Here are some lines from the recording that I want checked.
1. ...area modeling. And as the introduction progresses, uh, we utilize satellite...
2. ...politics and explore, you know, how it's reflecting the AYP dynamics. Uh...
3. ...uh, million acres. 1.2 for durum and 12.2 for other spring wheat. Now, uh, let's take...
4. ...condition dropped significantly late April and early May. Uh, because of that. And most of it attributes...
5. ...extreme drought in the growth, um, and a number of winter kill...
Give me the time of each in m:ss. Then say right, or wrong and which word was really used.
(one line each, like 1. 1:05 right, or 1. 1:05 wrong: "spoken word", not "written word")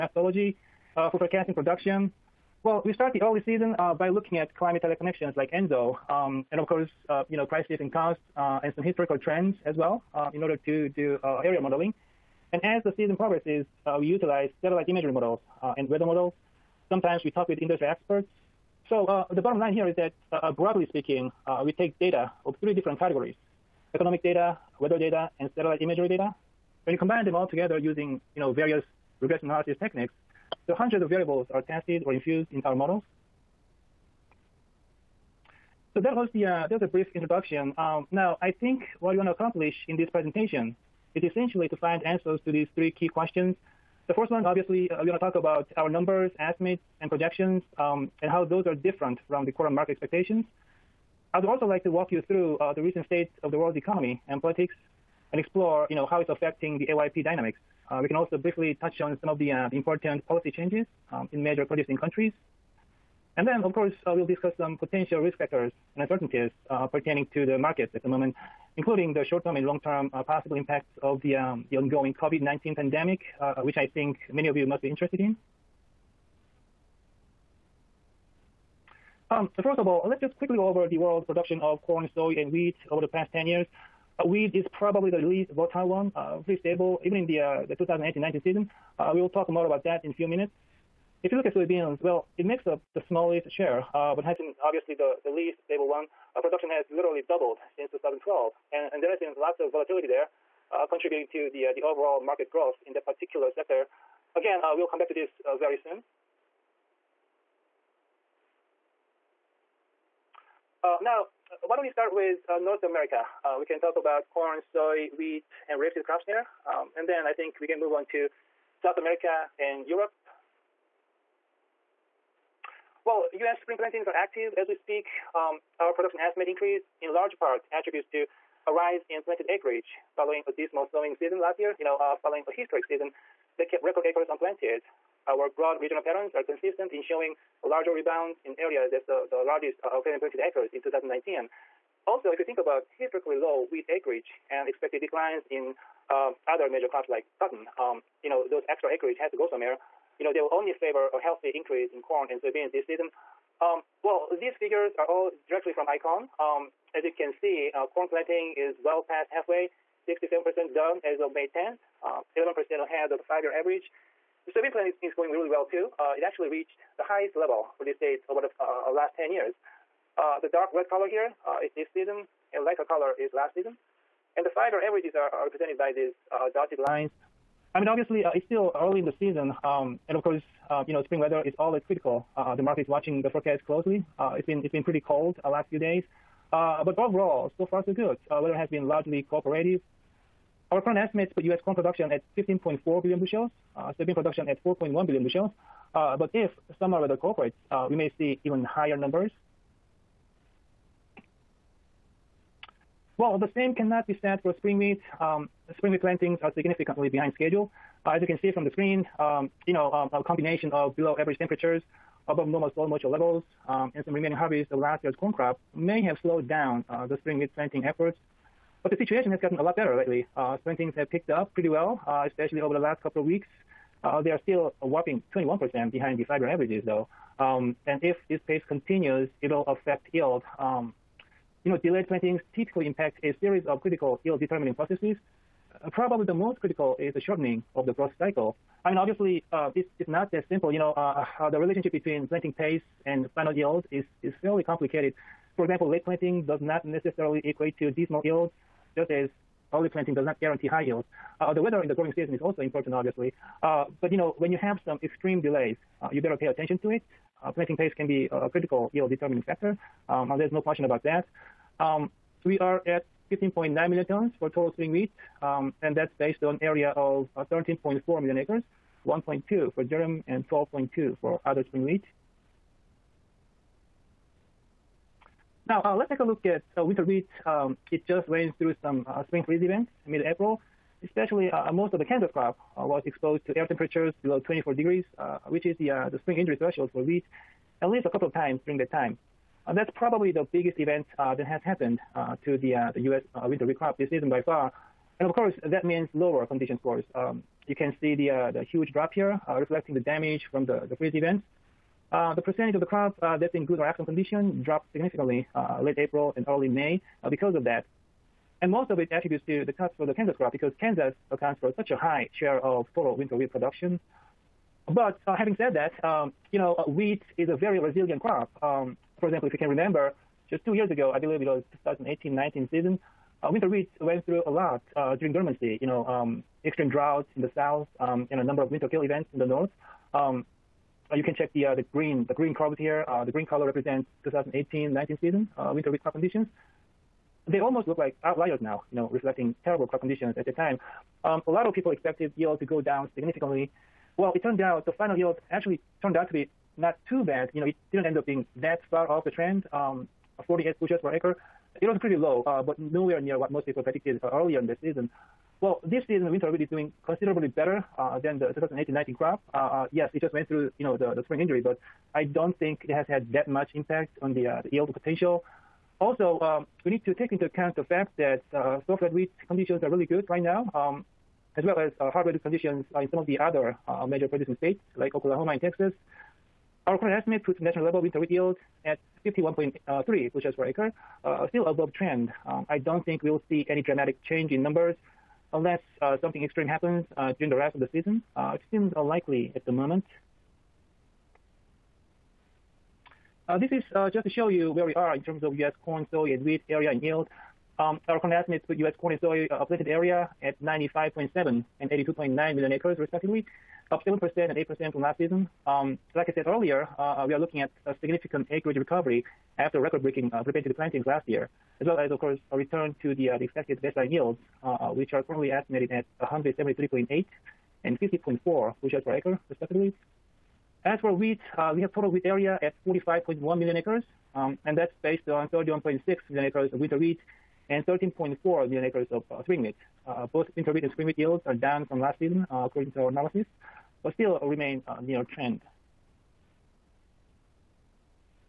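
1. 0:11 wrong: "season", not "introduction"
2. 0:54 wrong: "affecting", not "reflecting"
3. 4:28 right
4. 5:04 right
5. 5:26 wrong: "south", not "growth".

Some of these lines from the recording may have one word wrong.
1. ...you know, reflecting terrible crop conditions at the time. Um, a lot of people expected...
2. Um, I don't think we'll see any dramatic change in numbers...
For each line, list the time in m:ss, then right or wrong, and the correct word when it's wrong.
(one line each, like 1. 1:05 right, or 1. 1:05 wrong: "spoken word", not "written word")
1. 5:38 right
2. 6:22 right.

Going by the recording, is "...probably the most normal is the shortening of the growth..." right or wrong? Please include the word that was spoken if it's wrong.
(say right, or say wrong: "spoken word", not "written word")
wrong: "critical", not "normal".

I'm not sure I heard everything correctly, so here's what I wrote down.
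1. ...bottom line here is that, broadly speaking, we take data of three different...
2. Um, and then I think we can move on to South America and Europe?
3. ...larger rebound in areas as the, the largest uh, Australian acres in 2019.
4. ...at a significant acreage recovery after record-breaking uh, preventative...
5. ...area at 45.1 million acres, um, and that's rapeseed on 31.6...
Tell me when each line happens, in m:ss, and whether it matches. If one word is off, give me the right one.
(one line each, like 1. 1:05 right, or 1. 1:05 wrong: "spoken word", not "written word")
1. 0:19 right
2. 1:56 right
3. 2:17 right
4. 6:47 right
5. 7:02 wrong: "based", not "rapeseed".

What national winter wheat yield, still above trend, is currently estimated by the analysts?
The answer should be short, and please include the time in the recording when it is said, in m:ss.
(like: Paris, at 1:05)
51.3 bushels per acre, at 6:19.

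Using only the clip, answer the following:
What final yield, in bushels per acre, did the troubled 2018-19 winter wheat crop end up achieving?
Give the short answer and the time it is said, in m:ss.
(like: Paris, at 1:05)
48 bushels per acre, at 5:50.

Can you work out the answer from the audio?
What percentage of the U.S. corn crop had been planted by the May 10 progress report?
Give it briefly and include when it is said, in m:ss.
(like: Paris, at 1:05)
67%, at 2:40.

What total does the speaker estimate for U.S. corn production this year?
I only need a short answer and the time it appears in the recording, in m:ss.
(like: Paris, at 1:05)
15.4 billion bushels, at 3:12.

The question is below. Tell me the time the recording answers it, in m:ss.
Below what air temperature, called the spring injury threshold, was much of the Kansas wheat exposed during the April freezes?
4:44.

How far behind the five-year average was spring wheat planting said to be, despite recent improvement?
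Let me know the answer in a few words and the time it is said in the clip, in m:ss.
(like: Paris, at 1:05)
21%, at 3:45.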